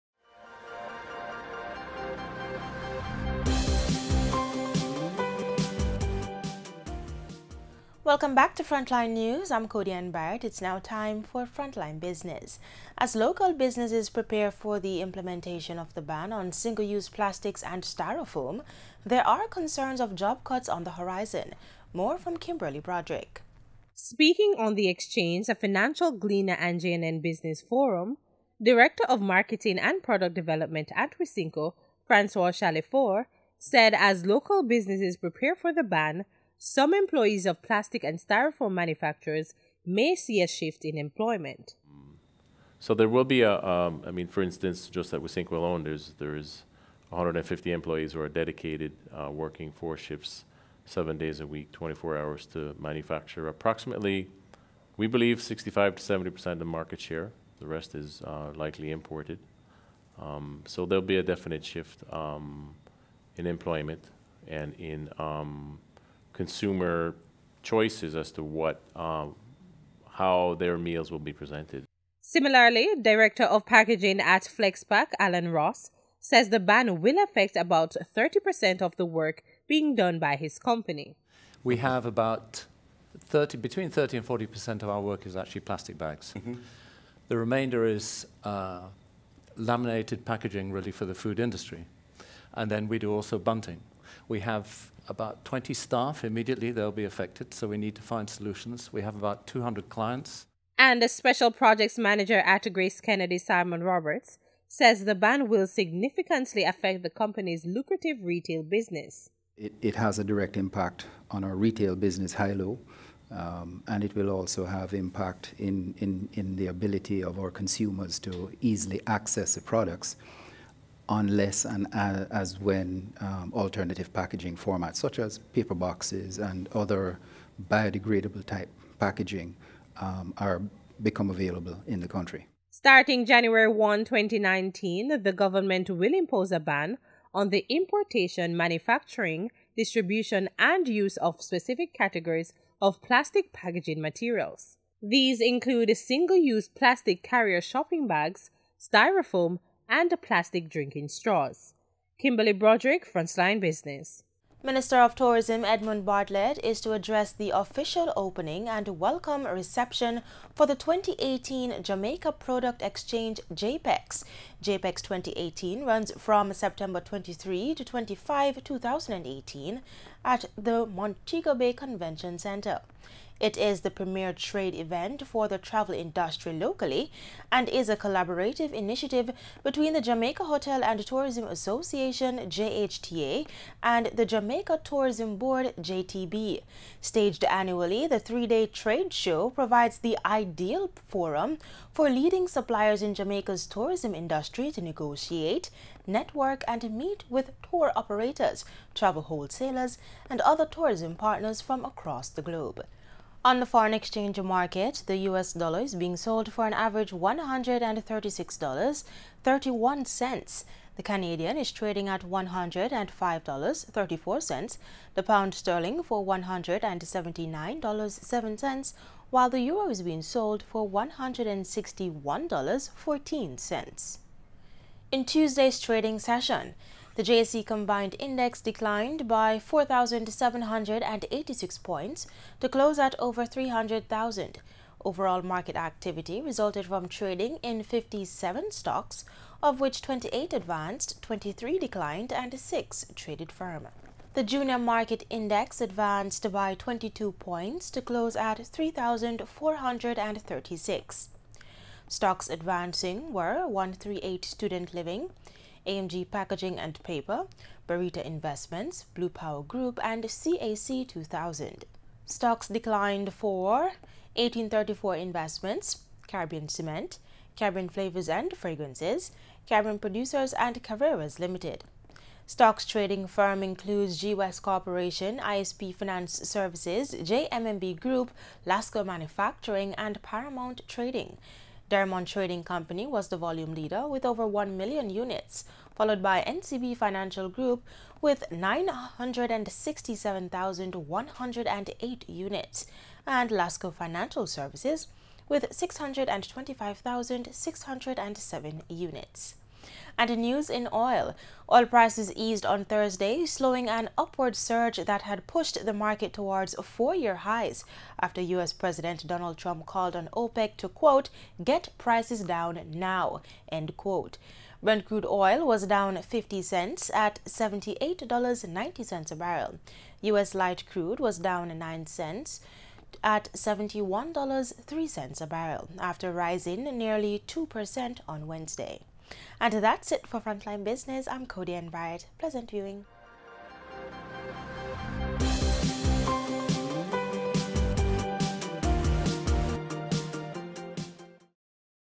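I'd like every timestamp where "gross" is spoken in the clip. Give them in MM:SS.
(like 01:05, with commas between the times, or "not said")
not said.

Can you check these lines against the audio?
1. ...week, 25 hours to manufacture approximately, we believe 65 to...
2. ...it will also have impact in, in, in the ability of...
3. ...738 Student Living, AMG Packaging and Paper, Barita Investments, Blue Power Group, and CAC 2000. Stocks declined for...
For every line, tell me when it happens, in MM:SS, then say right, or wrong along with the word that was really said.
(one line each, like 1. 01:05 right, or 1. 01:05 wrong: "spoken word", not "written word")
1. 00:51 wrong: "24", not "25"
2. 01:54 right
3. 04:13 wrong: "138", not "738".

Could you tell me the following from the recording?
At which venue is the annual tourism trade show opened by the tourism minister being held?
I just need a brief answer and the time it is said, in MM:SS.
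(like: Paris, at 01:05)
Montego Bay Convention Center, at 02:50.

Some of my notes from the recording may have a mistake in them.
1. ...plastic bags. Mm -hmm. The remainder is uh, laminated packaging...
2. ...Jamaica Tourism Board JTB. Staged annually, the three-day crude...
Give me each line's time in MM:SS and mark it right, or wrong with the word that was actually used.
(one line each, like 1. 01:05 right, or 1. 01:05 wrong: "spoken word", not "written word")
1. 01:25 right
2. 03:04 wrong: "trade", not "crude".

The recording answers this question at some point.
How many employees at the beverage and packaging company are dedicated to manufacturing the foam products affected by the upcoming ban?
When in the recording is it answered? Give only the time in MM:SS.
00:47.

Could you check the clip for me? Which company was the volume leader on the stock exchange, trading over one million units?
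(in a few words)
Derrimon Trading Company.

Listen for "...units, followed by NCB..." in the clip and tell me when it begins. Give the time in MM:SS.
04:45.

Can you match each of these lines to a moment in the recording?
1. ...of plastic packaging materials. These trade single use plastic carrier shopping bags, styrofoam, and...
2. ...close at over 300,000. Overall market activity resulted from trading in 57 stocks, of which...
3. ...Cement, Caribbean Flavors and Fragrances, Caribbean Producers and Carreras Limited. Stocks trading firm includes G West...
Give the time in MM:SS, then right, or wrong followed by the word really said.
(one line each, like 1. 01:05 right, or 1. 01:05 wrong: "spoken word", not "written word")
1. 02:22 wrong: "include", not "trade"
2. 03:52 right
3. 04:26 right.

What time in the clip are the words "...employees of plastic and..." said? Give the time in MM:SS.
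00:36.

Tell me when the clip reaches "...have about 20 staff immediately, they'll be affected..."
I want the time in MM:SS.
01:34.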